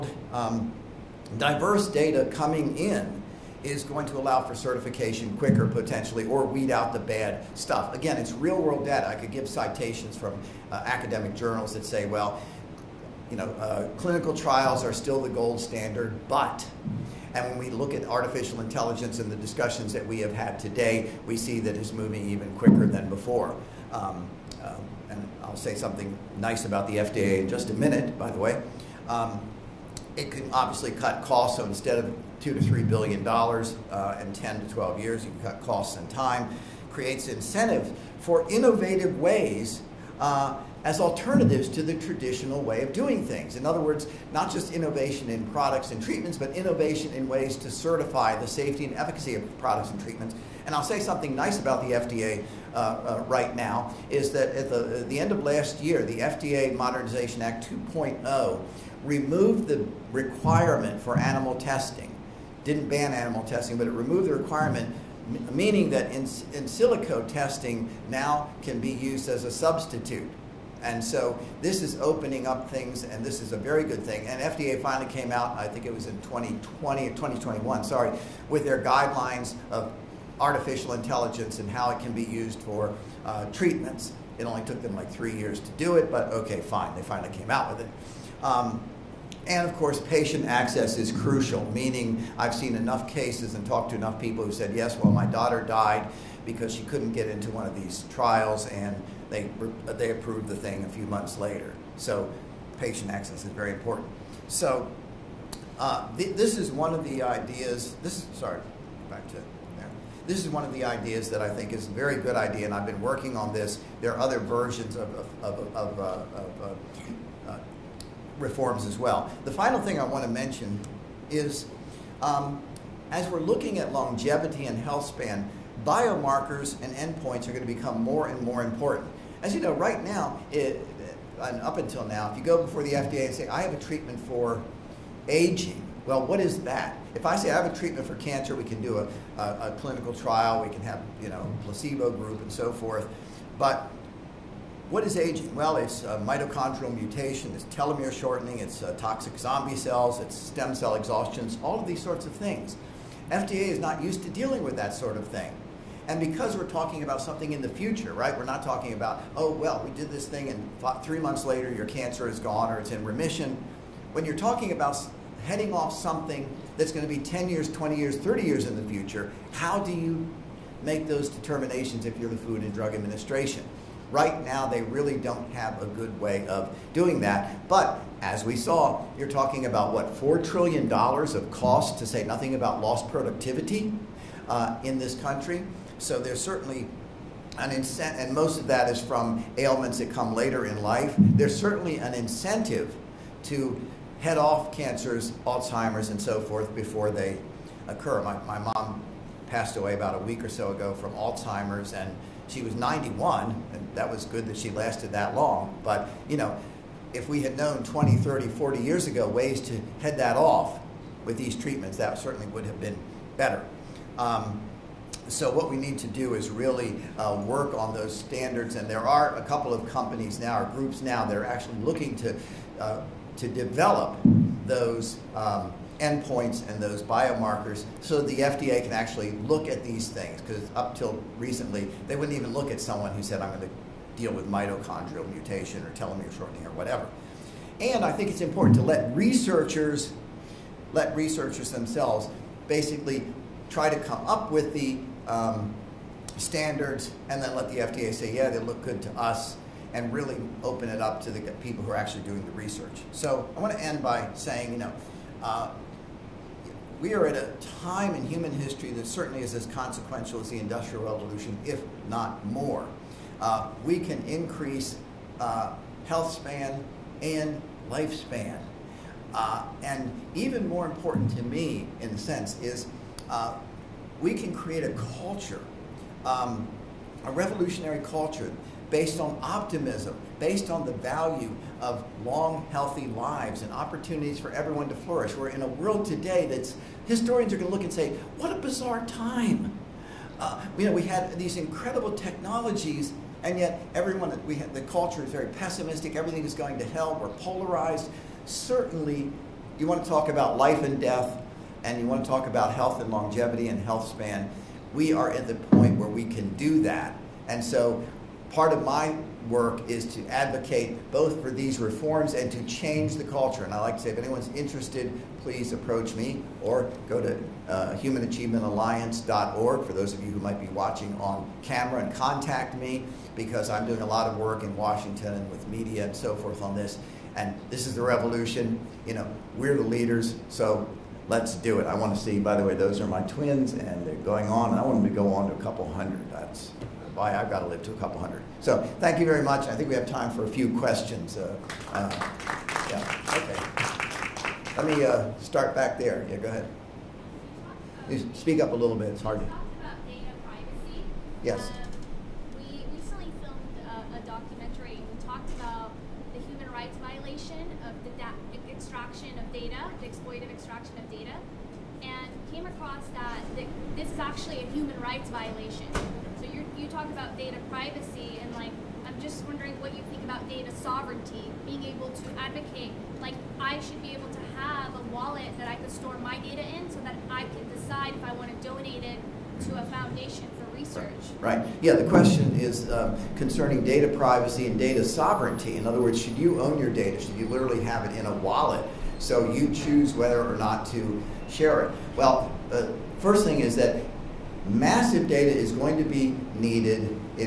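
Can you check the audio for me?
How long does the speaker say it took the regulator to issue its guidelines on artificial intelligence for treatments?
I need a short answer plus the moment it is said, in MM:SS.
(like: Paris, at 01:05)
3 years, at 01:25.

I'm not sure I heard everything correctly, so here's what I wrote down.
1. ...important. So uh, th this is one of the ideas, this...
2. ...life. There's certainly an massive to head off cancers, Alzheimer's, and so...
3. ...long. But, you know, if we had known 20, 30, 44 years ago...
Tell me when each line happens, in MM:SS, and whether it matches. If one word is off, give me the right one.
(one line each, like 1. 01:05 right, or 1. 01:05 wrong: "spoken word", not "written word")
1. 01:43 right
2. 03:10 wrong: "incentive", not "massive"
3. 03:25 wrong: "40", not "44".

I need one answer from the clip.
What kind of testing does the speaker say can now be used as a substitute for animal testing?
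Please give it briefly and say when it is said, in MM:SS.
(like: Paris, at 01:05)
in silico testing, at 01:06.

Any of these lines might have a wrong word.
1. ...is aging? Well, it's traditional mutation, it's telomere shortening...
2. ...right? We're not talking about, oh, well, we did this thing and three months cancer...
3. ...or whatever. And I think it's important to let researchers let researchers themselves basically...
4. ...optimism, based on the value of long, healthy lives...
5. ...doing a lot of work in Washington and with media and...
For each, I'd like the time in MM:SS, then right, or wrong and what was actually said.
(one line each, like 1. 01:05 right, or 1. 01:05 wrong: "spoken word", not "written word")
1. 02:25 wrong: "mitochondrial", not "traditional"
2. 02:38 wrong: "later", not "cancer"
3. 03:56 right
4. 04:39 right
5. 05:23 right.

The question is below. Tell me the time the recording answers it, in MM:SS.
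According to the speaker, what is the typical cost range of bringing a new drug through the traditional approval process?
00:32.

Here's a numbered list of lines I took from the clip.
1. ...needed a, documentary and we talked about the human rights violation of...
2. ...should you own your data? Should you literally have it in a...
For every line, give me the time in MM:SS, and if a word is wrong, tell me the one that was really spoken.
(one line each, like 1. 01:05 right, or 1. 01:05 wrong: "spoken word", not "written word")
1. 05:53 wrong: "filmed", not "needed"
2. 06:26 right.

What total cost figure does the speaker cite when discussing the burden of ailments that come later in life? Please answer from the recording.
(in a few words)
$4 trillion.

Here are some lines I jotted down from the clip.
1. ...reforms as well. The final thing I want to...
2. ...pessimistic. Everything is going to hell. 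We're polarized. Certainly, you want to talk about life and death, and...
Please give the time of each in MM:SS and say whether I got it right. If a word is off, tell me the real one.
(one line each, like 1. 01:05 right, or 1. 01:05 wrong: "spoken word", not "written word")
1. 01:58 right
2. 04:55 right.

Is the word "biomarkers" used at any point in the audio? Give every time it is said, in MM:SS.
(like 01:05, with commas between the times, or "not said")
02:05, 03:47.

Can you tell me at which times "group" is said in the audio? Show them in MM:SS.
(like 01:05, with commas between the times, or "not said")
02:22, 03:40.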